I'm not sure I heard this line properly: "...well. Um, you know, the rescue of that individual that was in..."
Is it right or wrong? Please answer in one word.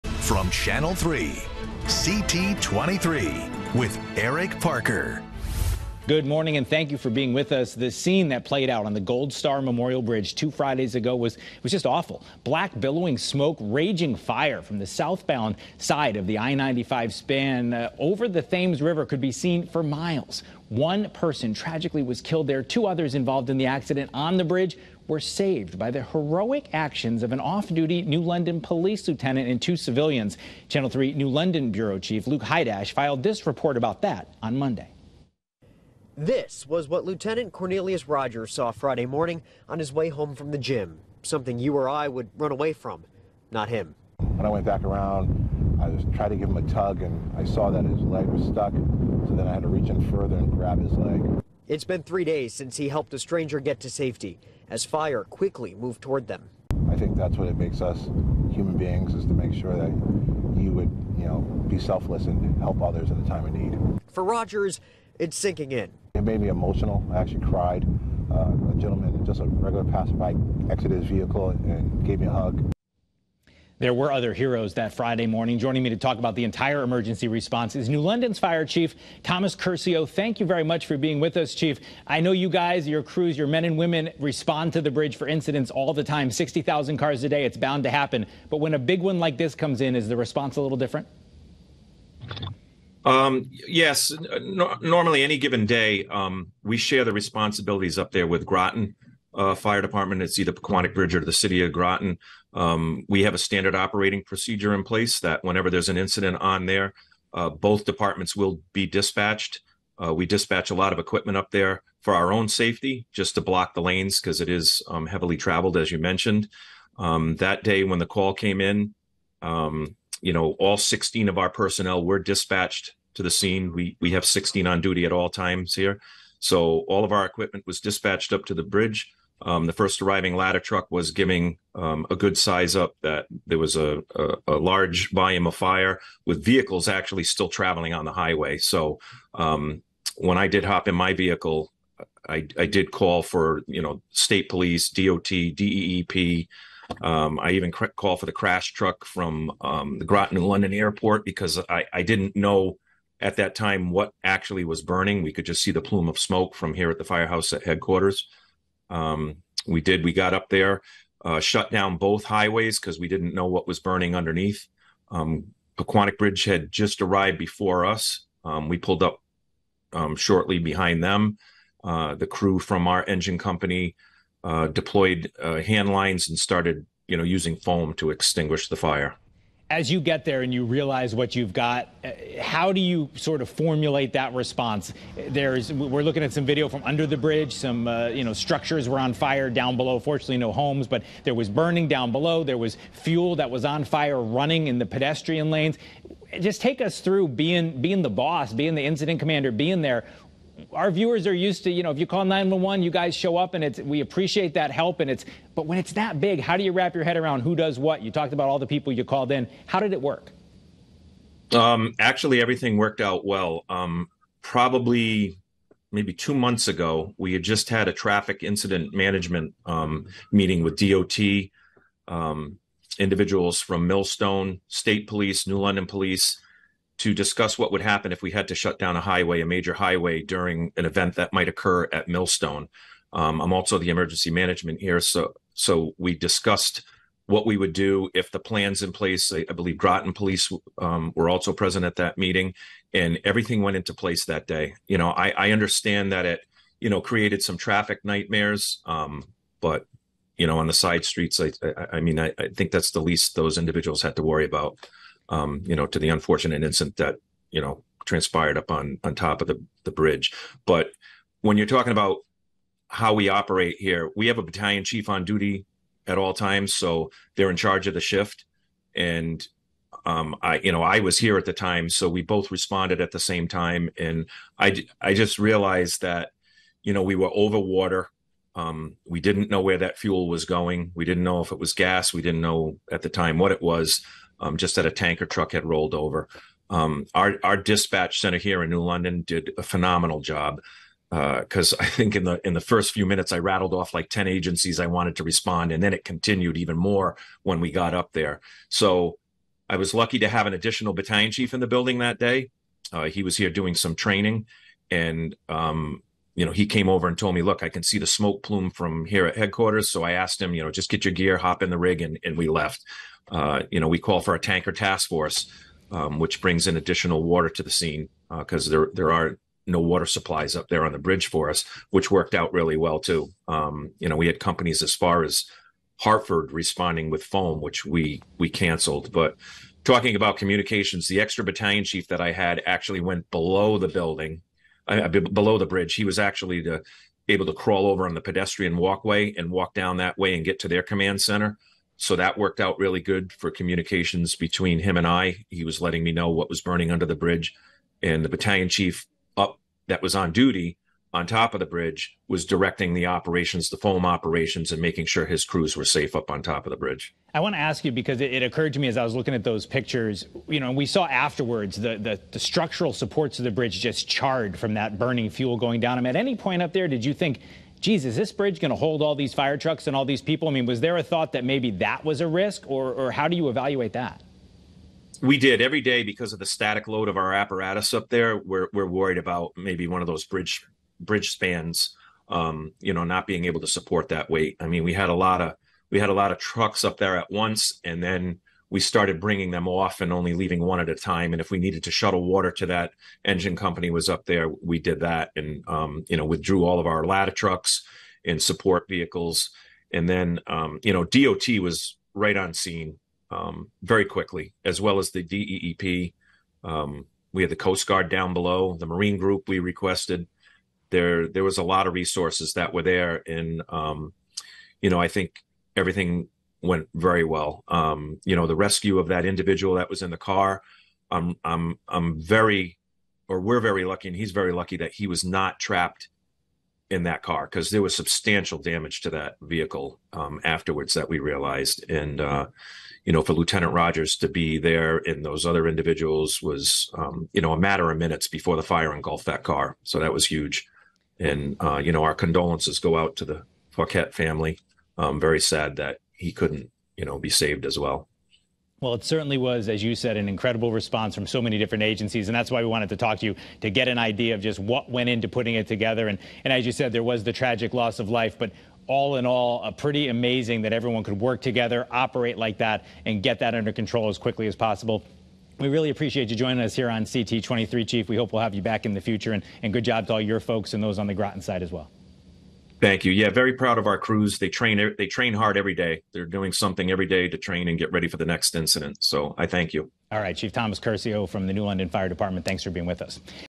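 right.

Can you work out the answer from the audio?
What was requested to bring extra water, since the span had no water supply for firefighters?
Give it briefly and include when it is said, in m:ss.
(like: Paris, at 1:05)
tanker task force, at 5:14.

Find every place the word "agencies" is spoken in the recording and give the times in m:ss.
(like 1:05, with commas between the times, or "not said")
4:54, 7:31.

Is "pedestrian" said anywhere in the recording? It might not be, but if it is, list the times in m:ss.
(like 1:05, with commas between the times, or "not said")
3:14, 5:38.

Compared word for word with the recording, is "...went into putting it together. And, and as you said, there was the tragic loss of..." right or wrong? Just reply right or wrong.
right.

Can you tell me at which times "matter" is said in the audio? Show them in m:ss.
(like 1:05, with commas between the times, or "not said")
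7:17.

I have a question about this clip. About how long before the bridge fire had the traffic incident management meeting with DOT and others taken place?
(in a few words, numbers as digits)
two months ago.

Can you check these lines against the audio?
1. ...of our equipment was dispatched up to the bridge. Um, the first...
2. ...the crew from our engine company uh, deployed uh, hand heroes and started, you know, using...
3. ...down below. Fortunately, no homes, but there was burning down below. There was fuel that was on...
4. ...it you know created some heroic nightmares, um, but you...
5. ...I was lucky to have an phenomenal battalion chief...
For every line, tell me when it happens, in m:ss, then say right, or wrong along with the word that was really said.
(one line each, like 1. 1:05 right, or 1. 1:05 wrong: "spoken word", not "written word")
1. 2:07 right
2. 2:52 wrong: "lines", not "heroes"
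3. 3:09 right
4. 4:06 wrong: "traffic", not "heroic"
5. 4:59 wrong: "additional", not "phenomenal".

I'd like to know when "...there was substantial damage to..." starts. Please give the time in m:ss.
7:07.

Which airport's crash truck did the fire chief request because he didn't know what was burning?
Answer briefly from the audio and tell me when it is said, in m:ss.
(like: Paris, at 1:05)
Groton and London Airport, at 2:30.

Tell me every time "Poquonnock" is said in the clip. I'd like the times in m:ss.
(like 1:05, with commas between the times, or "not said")
1:40, 2:45.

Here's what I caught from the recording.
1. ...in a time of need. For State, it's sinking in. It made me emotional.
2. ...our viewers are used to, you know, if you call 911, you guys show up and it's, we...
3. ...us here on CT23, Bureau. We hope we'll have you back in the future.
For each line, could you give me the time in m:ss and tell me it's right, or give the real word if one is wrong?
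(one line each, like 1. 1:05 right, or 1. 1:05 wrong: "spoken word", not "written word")
1. 1:03 wrong: "Rogers", not "State"
2. 3:20 right
3. 7:46 wrong: "Chief", not "Bureau".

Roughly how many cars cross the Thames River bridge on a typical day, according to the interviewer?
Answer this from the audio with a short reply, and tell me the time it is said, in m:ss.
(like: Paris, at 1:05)
60,000, at 1:26.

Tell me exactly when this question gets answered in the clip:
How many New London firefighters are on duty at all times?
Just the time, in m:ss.
2:00.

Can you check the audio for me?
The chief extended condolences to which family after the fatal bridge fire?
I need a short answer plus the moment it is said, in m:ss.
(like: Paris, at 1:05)
Fouquet, at 7:23.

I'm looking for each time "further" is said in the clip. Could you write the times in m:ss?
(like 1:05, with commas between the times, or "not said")
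0:50.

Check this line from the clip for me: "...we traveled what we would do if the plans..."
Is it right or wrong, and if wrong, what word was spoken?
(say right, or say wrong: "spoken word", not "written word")
wrong: "discussed", not "traveled".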